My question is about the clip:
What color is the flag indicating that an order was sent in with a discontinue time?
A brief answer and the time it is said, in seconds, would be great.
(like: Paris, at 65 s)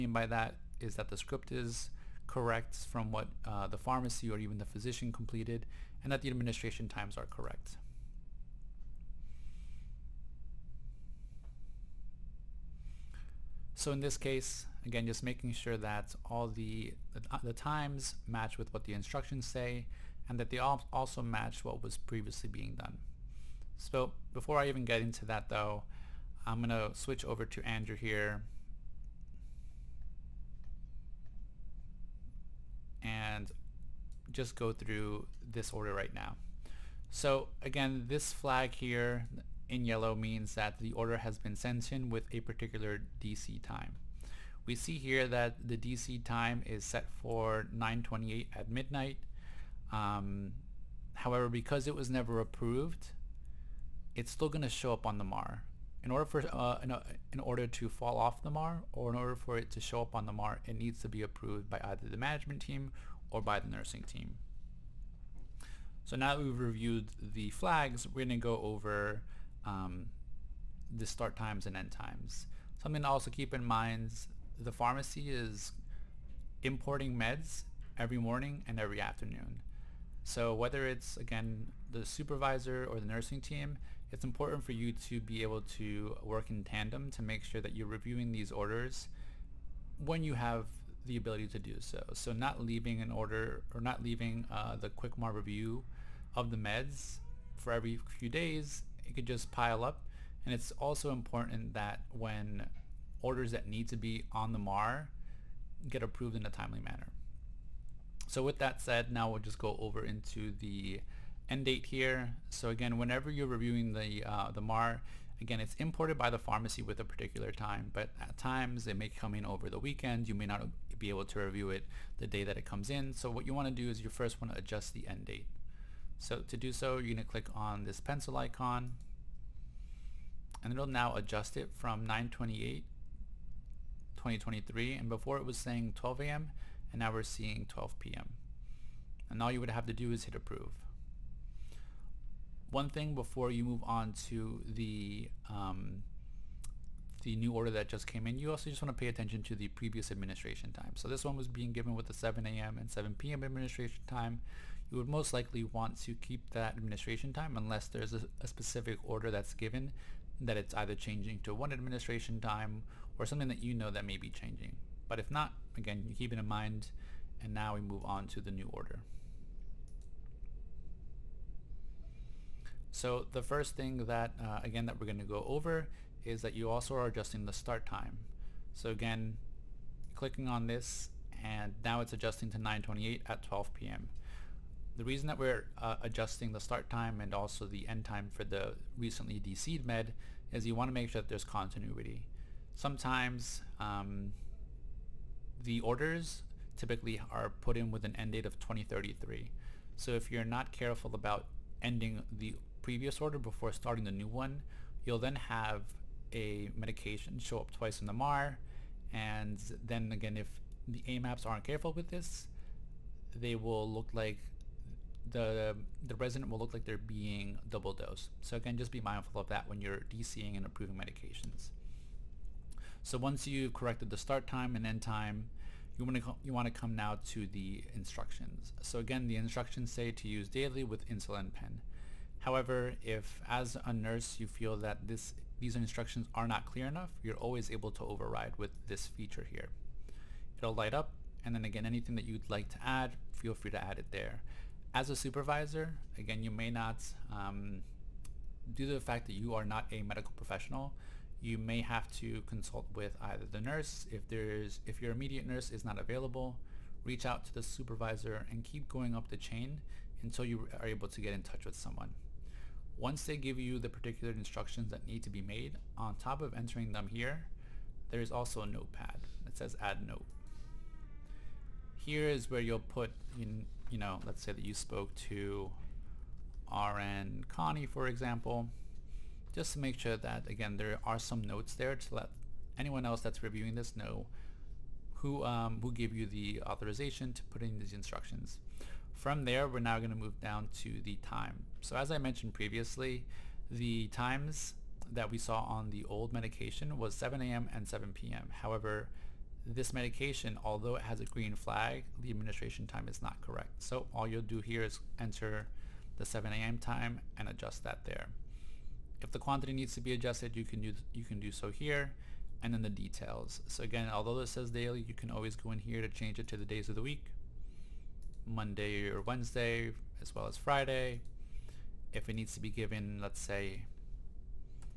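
Yellow, at 39 s.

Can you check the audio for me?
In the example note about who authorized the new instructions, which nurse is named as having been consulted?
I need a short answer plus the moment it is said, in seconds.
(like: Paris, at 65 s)
RN Connie, at 276 s.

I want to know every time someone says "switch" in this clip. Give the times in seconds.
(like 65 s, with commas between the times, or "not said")
26 s.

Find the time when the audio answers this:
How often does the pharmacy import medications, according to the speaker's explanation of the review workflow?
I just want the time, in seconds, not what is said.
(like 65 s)
77 s.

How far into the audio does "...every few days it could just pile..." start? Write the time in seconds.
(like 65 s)
97 s.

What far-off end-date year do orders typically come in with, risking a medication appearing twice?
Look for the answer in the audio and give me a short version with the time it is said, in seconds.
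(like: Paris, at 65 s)
2033, at 198 s.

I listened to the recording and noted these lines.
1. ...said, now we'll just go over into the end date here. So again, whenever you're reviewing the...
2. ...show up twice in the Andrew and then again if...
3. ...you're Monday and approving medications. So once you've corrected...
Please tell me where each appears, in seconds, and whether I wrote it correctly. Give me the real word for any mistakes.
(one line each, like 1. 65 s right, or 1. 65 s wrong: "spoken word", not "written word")
1. 108 s right
2. 207 s wrong: "MAR", not "Andrew"
3. 219 s wrong: "DCing", not "Monday".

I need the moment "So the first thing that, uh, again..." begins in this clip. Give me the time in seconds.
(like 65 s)
172 s.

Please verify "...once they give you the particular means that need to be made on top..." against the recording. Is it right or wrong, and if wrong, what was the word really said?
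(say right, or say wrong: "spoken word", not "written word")
wrong: "instructions", not "means".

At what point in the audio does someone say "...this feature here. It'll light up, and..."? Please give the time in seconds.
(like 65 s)
238 s.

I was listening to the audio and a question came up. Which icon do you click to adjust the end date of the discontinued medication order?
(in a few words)
Pencil icon.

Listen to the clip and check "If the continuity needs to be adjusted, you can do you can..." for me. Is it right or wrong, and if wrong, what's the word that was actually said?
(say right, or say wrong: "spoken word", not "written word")
wrong: "quantity", not "continuity".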